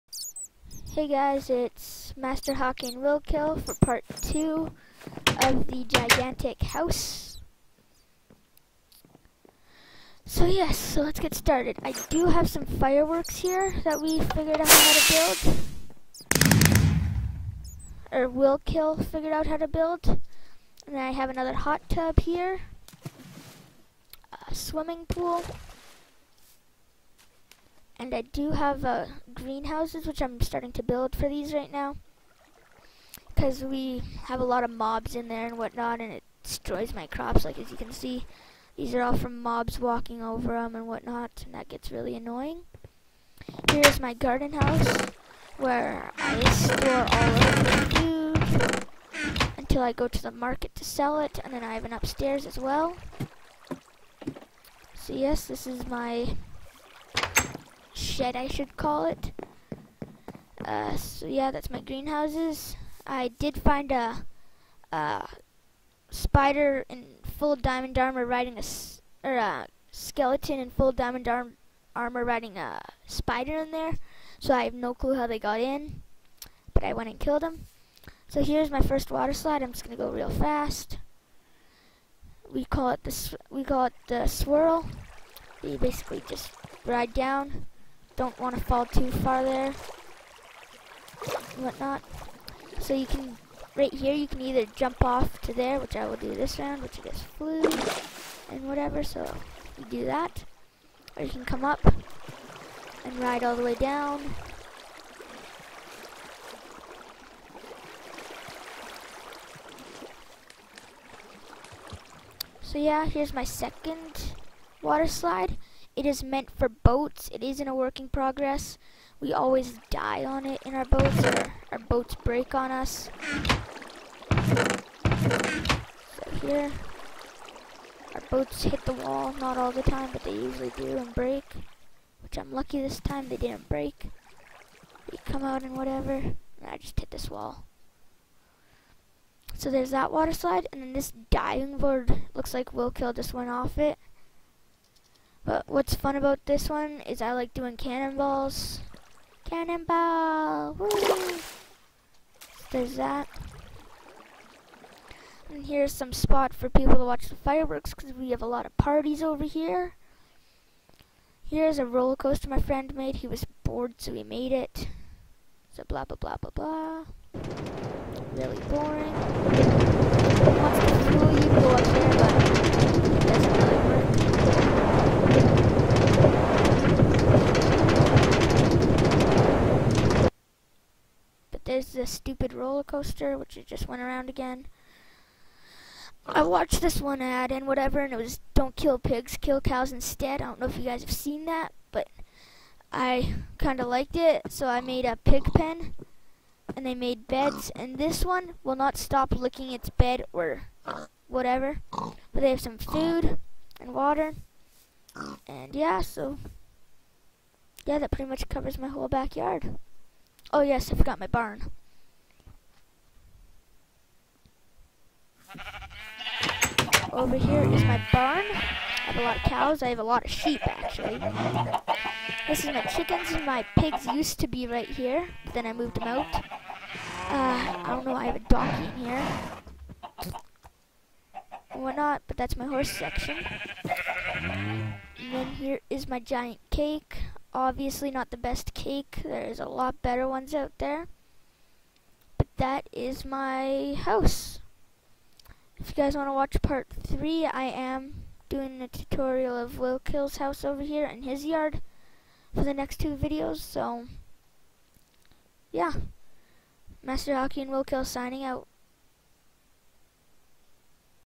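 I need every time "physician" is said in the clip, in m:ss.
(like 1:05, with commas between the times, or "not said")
not said.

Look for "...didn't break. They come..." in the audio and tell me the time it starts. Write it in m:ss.
2:13.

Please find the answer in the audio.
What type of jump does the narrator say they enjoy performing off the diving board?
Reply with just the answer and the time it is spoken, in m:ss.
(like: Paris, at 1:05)
Cannonballs, at 2:27.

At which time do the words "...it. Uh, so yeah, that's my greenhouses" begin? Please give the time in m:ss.
0:59.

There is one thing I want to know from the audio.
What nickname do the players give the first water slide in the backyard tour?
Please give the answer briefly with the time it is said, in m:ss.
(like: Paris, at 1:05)
The Swirl, at 1:24.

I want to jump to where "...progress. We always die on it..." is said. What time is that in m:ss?
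1:58.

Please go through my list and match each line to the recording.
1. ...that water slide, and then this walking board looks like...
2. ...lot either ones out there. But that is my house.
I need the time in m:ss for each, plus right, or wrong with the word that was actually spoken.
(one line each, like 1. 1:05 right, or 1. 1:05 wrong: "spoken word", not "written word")
1. 2:19 wrong: "diving", not "walking"
2. 3:59 wrong: "better", not "either".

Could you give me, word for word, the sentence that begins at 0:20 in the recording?
And I have another hot tub here.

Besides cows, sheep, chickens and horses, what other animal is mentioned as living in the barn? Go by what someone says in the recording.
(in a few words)
A donkey.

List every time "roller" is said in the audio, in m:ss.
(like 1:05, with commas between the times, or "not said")
2:41, 3:02.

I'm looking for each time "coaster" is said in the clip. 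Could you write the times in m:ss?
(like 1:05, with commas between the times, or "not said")
2:42, 3:02.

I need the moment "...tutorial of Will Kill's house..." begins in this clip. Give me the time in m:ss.
4:08.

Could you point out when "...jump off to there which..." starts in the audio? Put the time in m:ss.
1:34.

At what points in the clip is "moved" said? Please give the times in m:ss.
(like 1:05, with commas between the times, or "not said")
3:45.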